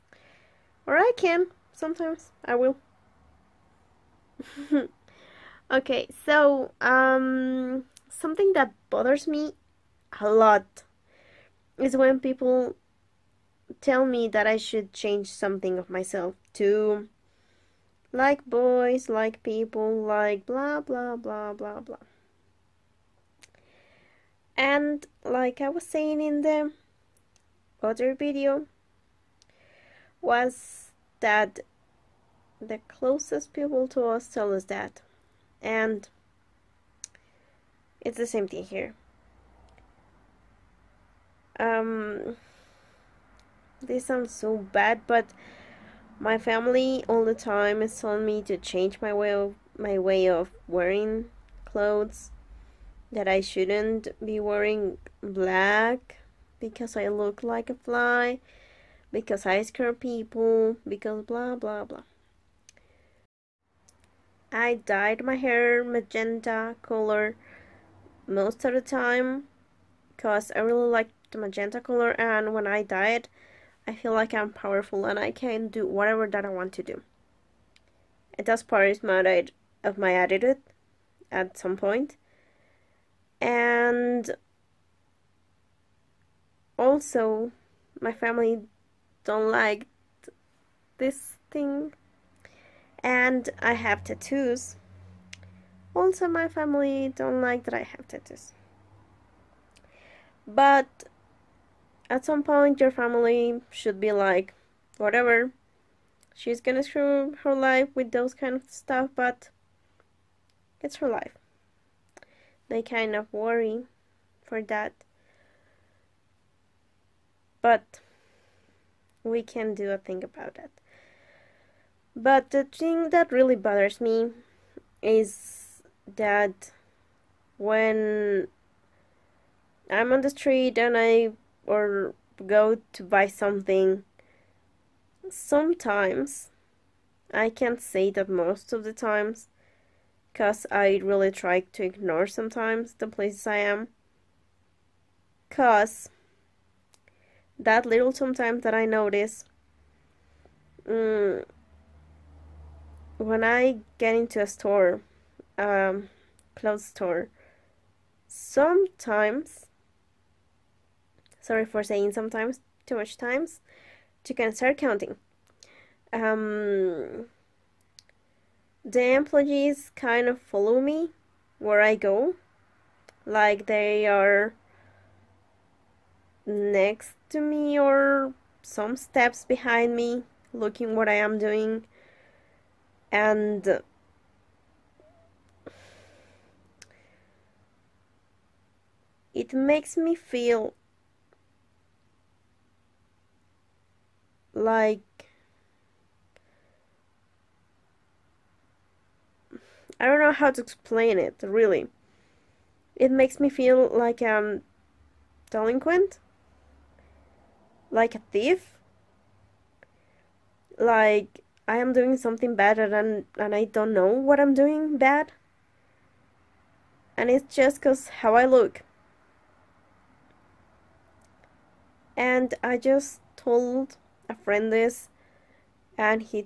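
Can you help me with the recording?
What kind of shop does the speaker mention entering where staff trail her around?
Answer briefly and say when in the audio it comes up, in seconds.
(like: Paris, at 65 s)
clothes store, at 156 s.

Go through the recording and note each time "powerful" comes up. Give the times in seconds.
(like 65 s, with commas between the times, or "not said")
74 s.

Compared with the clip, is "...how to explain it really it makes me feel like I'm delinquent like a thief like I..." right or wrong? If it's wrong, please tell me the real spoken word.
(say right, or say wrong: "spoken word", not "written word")
right.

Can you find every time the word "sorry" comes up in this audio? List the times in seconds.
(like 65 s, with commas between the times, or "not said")
161 s.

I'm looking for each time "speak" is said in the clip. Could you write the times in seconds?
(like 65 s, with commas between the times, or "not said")
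not said.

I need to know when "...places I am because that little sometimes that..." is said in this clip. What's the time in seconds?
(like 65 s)
143 s.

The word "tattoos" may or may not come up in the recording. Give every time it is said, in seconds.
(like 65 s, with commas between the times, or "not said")
94 s, 98 s.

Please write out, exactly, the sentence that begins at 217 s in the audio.
And it's just because how I look.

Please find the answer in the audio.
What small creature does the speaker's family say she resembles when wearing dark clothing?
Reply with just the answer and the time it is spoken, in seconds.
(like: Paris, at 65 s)
a fly, at 57 s.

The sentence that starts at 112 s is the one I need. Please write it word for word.
They kind of worry for that.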